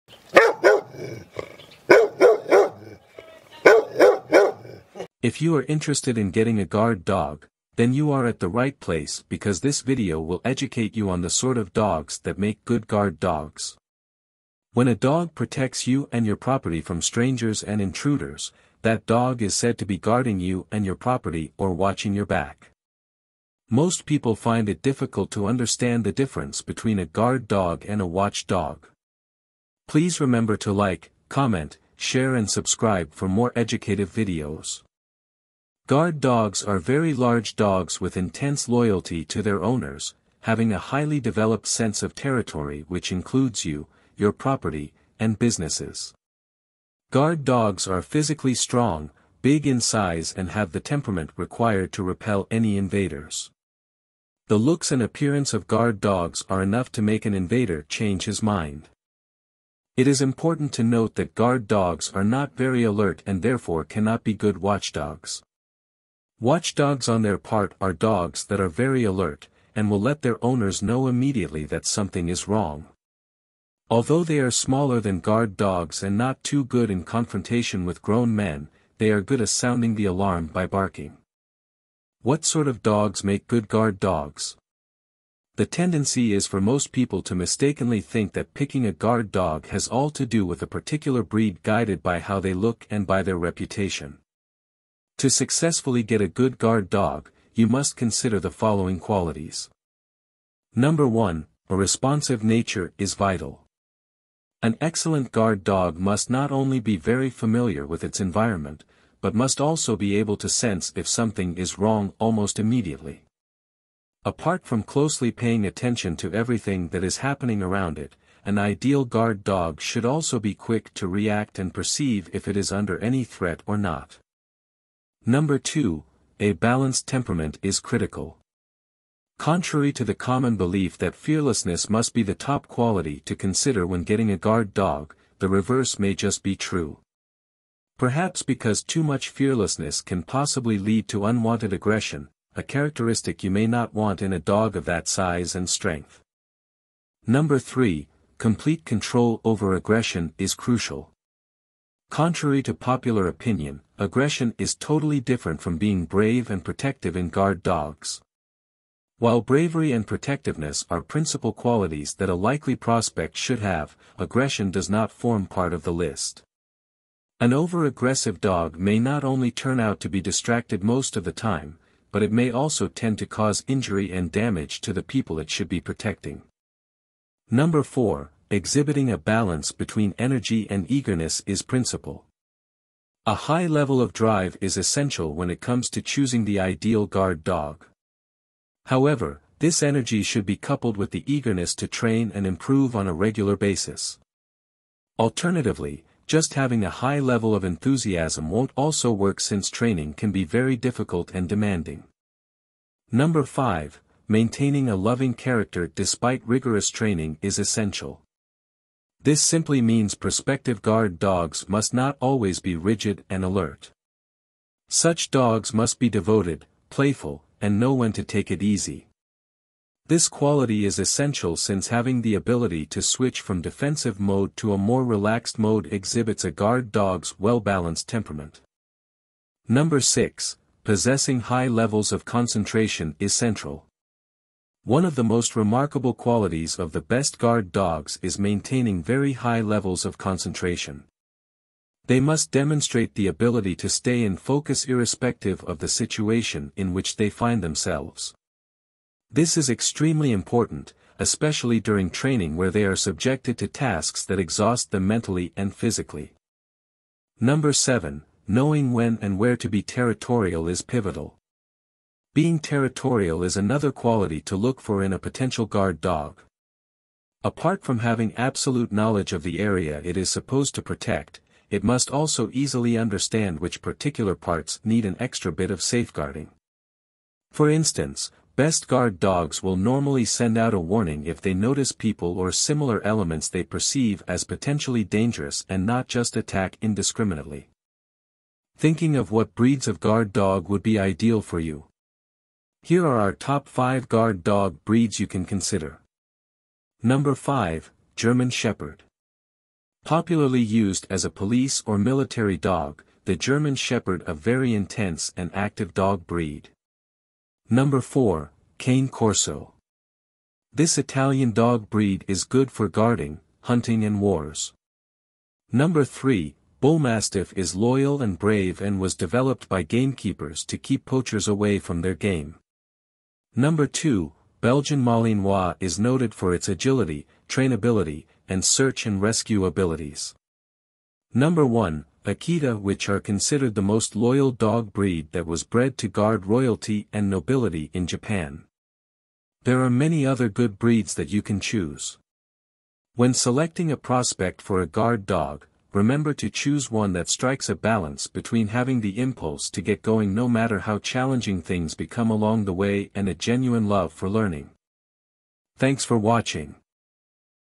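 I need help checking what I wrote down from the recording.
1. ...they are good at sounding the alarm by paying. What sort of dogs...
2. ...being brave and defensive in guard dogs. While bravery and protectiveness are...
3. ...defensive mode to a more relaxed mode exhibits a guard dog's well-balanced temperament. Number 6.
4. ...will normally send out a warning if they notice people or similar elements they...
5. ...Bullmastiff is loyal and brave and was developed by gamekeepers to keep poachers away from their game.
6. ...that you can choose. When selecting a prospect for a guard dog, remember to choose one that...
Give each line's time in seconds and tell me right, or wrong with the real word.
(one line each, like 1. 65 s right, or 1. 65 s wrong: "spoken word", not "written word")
1. 78 s wrong: "barking", not "paying"
2. 155 s wrong: "protective", not "defensive"
3. 223 s right
4. 279 s right
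5. 316 s right
6. 341 s right.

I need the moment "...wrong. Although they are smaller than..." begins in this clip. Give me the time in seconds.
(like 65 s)
72 s.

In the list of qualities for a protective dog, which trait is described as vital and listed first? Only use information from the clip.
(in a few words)
A responsive nature.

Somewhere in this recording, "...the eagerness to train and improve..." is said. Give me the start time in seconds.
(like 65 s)
191 s.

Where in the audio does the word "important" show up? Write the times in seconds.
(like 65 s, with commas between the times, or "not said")
60 s, 250 s.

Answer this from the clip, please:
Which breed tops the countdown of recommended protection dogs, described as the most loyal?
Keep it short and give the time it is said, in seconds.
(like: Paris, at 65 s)
Akita, at 332 s.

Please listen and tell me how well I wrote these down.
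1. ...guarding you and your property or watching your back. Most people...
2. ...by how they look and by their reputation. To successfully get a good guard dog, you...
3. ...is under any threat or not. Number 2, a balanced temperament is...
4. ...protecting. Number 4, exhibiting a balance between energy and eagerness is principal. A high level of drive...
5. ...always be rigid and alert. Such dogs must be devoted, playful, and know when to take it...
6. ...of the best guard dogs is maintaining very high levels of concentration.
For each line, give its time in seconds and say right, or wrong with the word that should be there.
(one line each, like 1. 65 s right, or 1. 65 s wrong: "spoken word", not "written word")
1. 19 s right
2. 92 s right
3. 122 s right
4. 175 s right
5. 212 s right
6. 236 s right.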